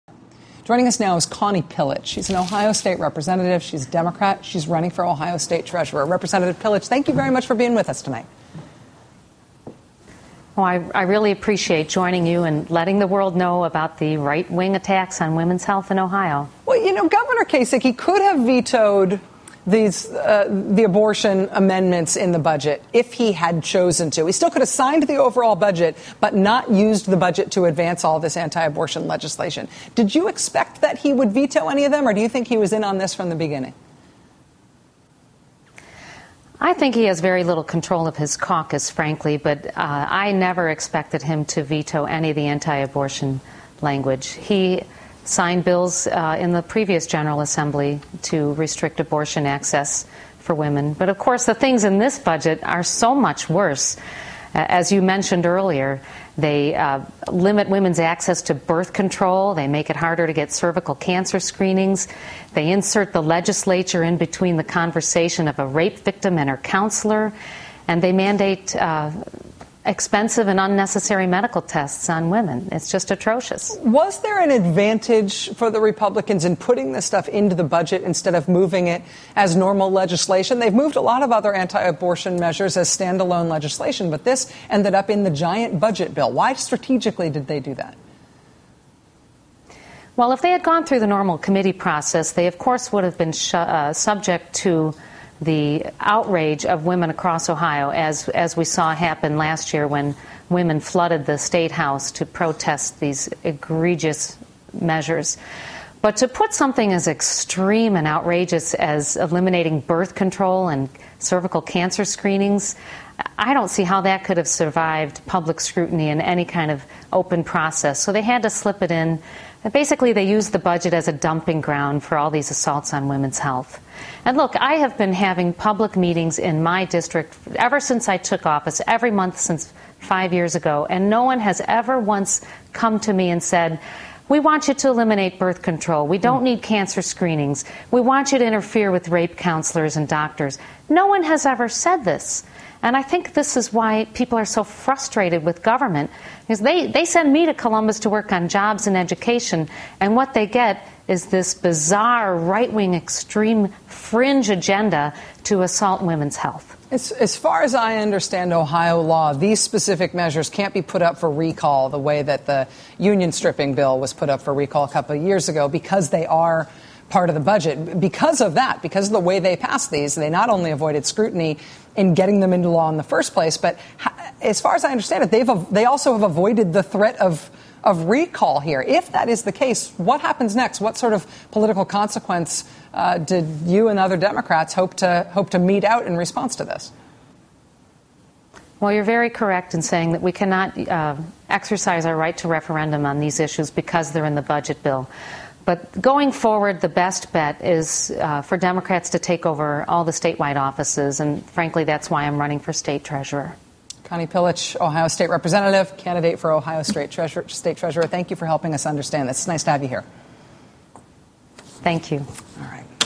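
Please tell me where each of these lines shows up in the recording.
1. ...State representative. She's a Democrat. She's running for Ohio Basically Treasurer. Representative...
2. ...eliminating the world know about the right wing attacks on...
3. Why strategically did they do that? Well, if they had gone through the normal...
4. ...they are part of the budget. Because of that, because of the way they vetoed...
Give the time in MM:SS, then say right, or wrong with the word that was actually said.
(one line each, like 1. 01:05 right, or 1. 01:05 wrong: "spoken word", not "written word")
1. 00:02 wrong: "State", not "Basically"
2. 00:12 wrong: "letting", not "eliminating"
3. 01:26 right
4. 02:46 wrong: "passed", not "vetoed".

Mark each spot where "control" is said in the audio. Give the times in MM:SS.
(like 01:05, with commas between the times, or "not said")
00:37, 00:58, 01:50, 02:15.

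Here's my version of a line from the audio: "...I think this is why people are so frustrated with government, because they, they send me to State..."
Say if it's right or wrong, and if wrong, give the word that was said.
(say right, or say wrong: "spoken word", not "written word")
wrong: "Columbus", not "State".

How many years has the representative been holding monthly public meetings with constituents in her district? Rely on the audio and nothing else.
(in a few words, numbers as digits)
5.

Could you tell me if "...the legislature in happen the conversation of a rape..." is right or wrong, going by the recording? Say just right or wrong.
wrong.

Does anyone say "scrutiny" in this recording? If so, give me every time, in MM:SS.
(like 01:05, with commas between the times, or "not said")
01:55, 02:51.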